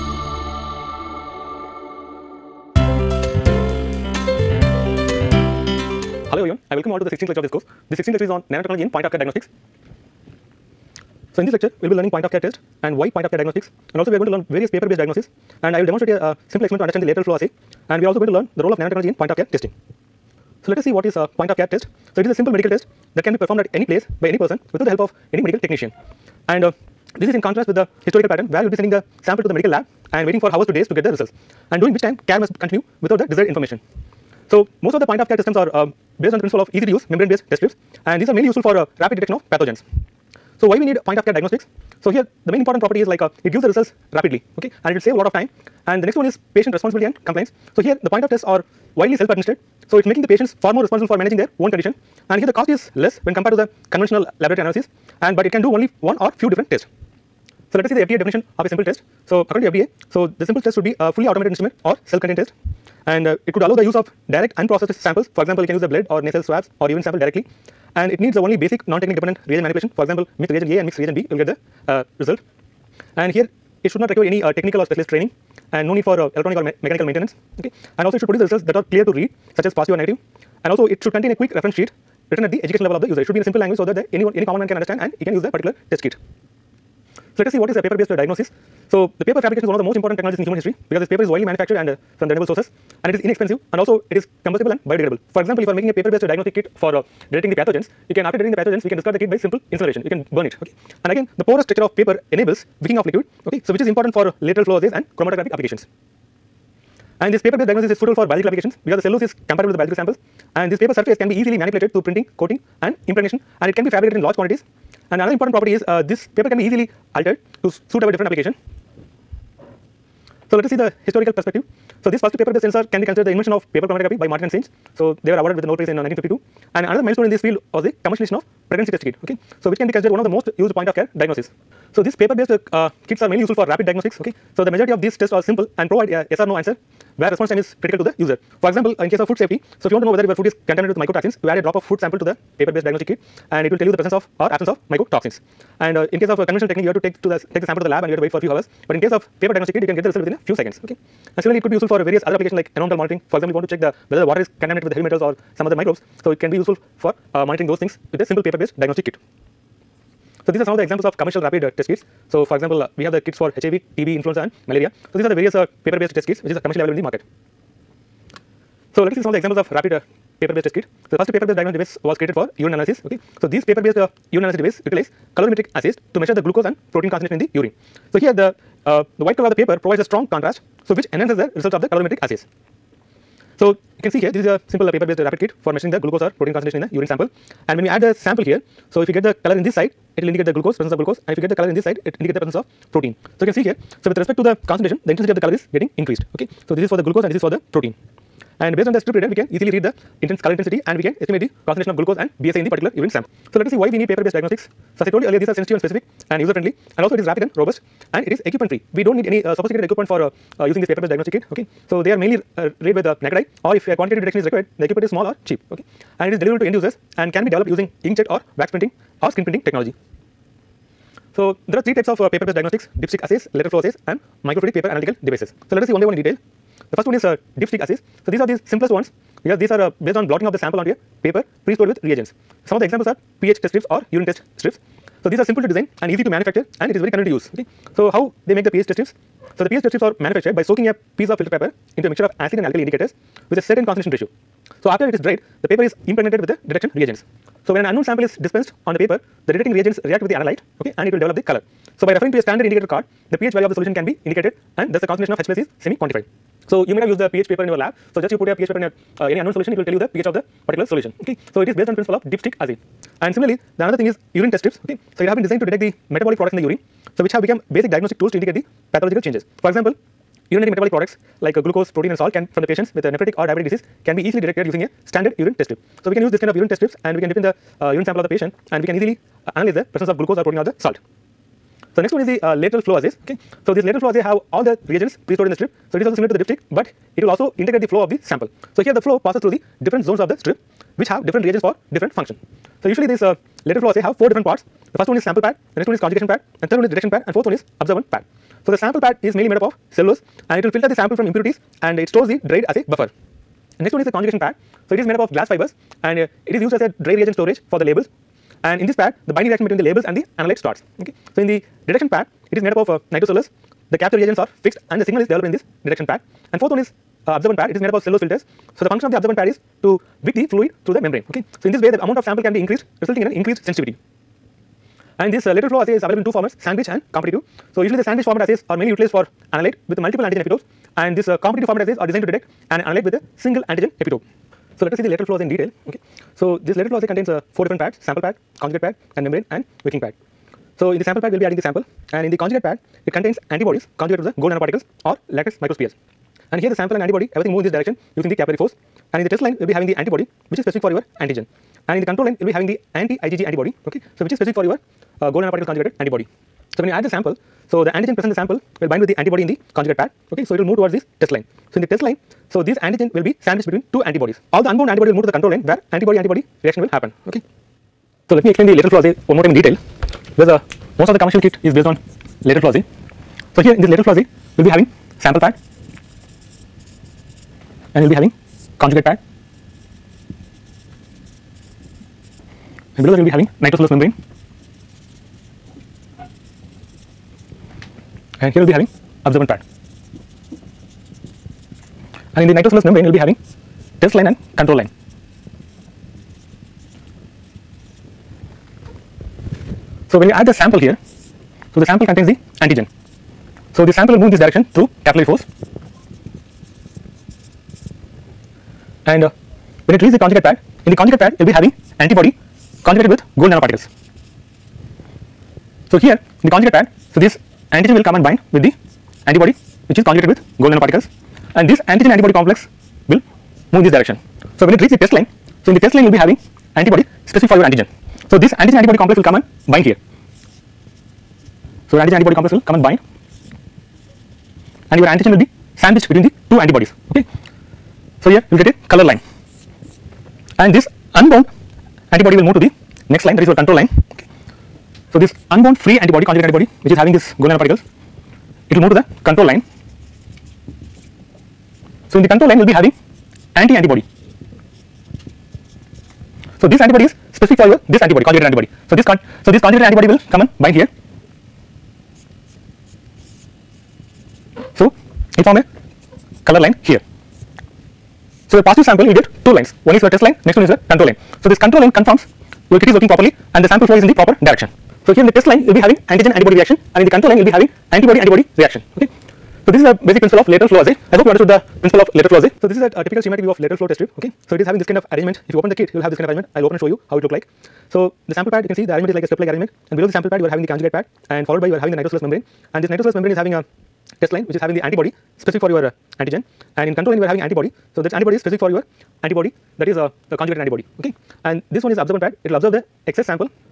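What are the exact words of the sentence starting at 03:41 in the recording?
So, there are three types of uh, paper based diagnostics dipstick assays, lateral flow assays and microfluidic paper analytical devices.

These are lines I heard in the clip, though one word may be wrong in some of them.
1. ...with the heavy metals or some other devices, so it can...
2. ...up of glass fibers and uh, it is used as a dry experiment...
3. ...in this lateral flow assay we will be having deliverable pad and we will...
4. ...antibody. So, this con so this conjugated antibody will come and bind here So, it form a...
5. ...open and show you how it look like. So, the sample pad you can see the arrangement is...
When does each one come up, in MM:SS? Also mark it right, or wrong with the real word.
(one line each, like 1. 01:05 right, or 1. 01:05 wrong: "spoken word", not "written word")
1. 02:34 wrong: "microbes", not "devices"
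2. 05:05 wrong: "reagent", not "experiment"
3. 06:13 wrong: "sample", not "deliverable"
4. 07:38 right
5. 08:06 right.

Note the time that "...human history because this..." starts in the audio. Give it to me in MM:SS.
01:30.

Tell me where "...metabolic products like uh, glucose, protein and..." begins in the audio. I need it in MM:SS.
04:30.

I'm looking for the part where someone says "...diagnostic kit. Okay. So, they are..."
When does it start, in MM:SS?
03:31.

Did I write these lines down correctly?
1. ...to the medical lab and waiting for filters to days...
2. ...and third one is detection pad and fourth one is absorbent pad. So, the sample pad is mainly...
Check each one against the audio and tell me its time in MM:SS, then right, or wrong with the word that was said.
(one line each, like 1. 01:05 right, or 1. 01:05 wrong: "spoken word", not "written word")
1. 00:29 wrong: "hours", not "filters"
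2. 04:56 right.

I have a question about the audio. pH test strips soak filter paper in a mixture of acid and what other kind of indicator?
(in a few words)
alkali.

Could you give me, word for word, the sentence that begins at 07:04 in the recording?
So, when it reaches the test line, so in the test line you will be having antibody specific for your antigen.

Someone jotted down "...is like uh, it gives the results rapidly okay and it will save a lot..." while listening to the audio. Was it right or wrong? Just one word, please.
right.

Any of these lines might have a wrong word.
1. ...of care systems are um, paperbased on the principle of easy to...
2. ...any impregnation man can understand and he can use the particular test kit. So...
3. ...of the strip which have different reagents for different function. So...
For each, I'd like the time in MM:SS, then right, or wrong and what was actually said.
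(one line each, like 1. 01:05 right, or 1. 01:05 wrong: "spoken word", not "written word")
1. 00:35 wrong: "based", not "paperbased"
2. 01:24 wrong: "common", not "impregnation"
3. 04:50 right.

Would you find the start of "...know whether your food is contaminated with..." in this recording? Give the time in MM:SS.
02:20.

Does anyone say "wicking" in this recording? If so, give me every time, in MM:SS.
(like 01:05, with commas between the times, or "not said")
01:42, 05:39.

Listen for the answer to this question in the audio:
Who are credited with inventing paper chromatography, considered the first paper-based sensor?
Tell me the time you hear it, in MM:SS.
02:04.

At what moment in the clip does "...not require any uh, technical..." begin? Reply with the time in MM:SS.
01:13.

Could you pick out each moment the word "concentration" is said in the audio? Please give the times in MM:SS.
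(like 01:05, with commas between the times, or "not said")
02:57, 03:06, 03:14, 03:21, 04:03, 04:15.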